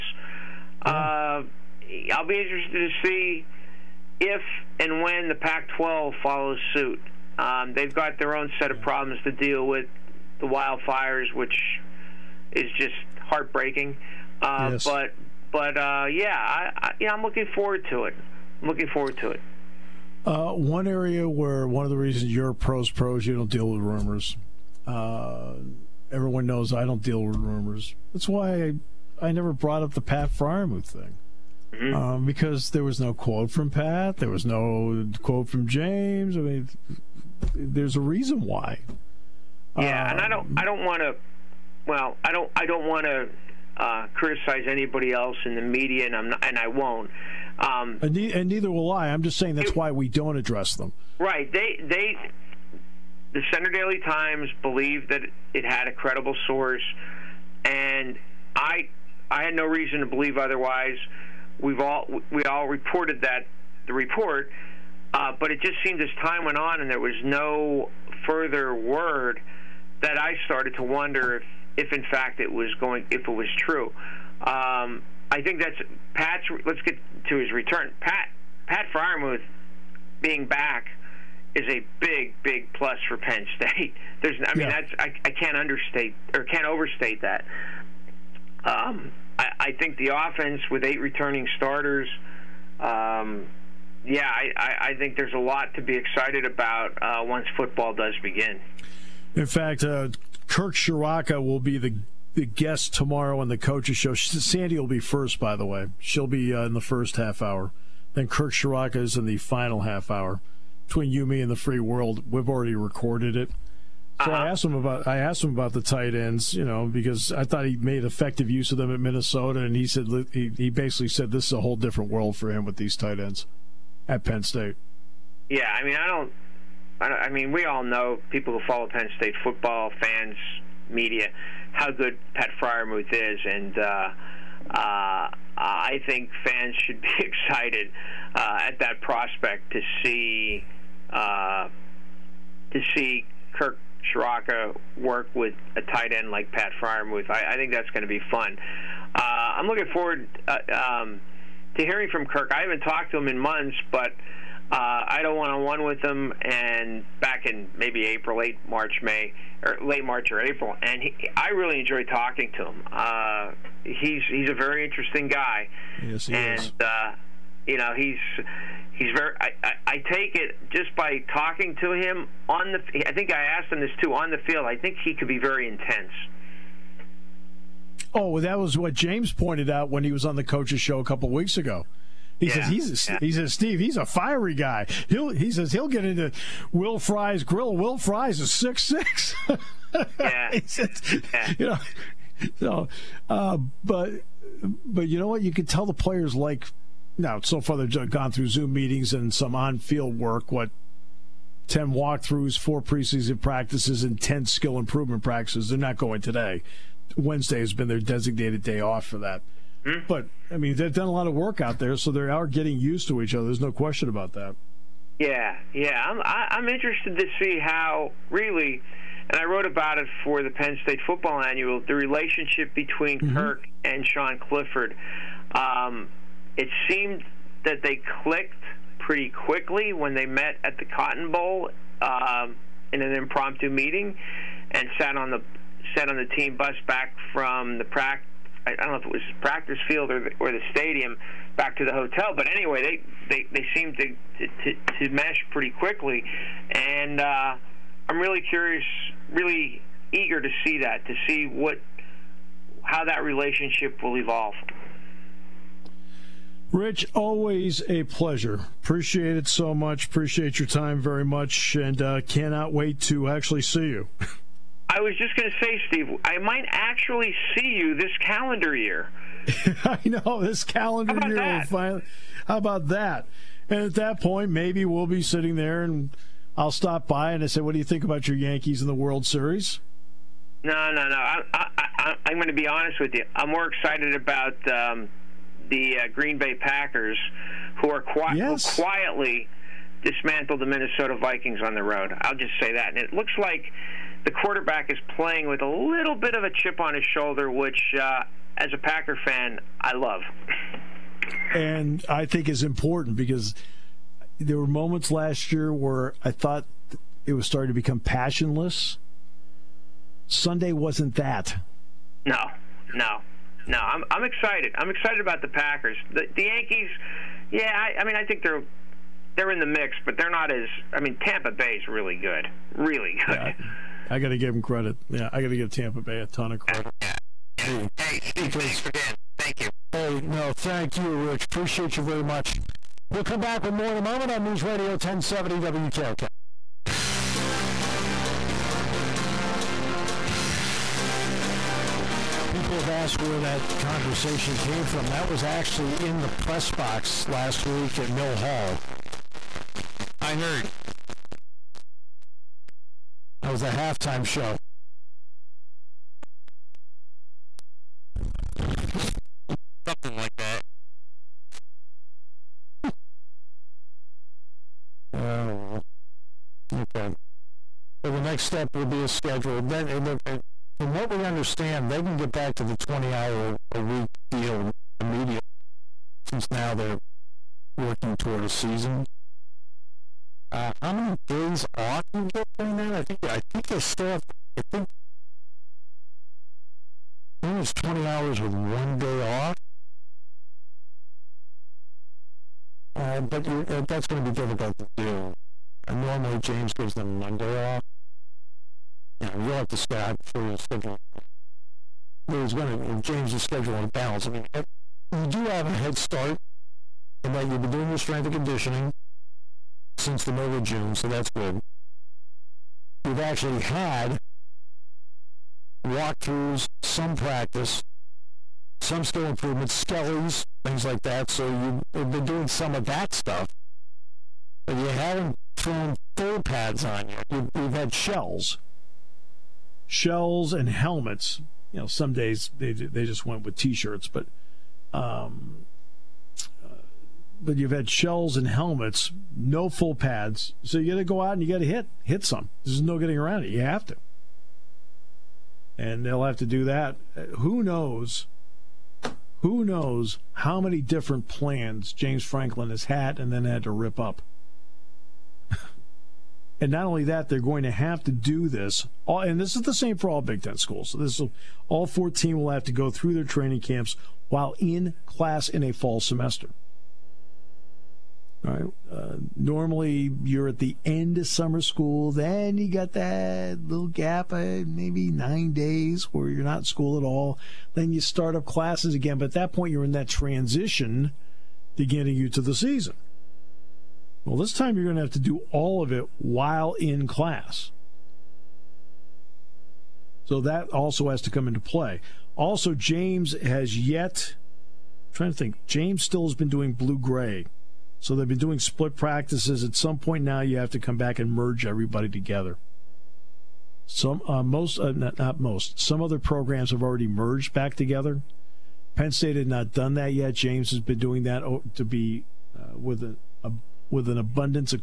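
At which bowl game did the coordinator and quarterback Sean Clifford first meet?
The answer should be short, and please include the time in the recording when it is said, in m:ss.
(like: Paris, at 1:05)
Cotton Bowl, at 3:50.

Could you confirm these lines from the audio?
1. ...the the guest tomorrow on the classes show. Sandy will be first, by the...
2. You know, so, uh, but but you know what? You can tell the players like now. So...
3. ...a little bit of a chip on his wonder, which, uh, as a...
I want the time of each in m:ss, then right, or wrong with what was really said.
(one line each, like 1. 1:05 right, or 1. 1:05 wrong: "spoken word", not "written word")
1. 1:41 wrong: "coaches", not "classes"
2. 3:11 right
3. 4:55 wrong: "shoulder", not "wonder".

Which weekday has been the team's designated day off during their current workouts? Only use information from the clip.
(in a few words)
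Wednesday.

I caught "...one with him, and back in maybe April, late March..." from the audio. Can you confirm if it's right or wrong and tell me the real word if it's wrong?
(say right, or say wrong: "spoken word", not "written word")
right.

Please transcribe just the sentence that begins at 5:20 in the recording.
I mean, Tampa Bay's really good, really good.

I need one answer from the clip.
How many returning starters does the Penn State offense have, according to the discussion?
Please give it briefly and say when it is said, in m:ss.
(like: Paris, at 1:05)
8, at 1:30.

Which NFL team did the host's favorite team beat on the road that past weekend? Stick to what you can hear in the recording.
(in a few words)
Minnesota Vikings.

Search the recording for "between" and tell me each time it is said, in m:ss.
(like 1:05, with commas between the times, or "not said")
1:50, 3:42.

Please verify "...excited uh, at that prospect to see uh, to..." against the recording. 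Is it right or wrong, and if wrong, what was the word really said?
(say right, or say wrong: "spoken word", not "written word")
right.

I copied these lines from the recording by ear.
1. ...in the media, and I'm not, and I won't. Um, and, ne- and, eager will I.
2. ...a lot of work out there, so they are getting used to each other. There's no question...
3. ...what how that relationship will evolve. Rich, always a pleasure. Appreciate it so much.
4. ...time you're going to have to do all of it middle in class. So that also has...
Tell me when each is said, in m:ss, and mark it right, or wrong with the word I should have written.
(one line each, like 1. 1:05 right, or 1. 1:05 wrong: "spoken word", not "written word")
1. 0:45 wrong: "neither", not "eager"
2. 3:31 right
3. 4:11 right
4. 8:04 wrong: "while", not "middle".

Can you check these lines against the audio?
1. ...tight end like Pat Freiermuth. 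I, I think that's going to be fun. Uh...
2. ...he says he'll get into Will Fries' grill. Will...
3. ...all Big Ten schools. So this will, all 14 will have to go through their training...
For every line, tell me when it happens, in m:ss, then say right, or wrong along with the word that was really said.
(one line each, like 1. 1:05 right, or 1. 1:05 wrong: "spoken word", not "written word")
1. 2:25 right
2. 3:05 right
3. 7:40 right.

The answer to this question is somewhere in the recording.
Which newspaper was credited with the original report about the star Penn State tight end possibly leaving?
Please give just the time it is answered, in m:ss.
0:53.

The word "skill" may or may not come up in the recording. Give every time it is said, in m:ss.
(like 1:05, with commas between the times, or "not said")
3:24, 6:59.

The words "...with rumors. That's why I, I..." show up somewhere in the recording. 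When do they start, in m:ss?
0:27.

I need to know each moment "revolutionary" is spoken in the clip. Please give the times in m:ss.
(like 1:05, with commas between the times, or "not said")
not said.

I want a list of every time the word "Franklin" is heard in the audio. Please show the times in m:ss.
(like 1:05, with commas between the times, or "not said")
7:32.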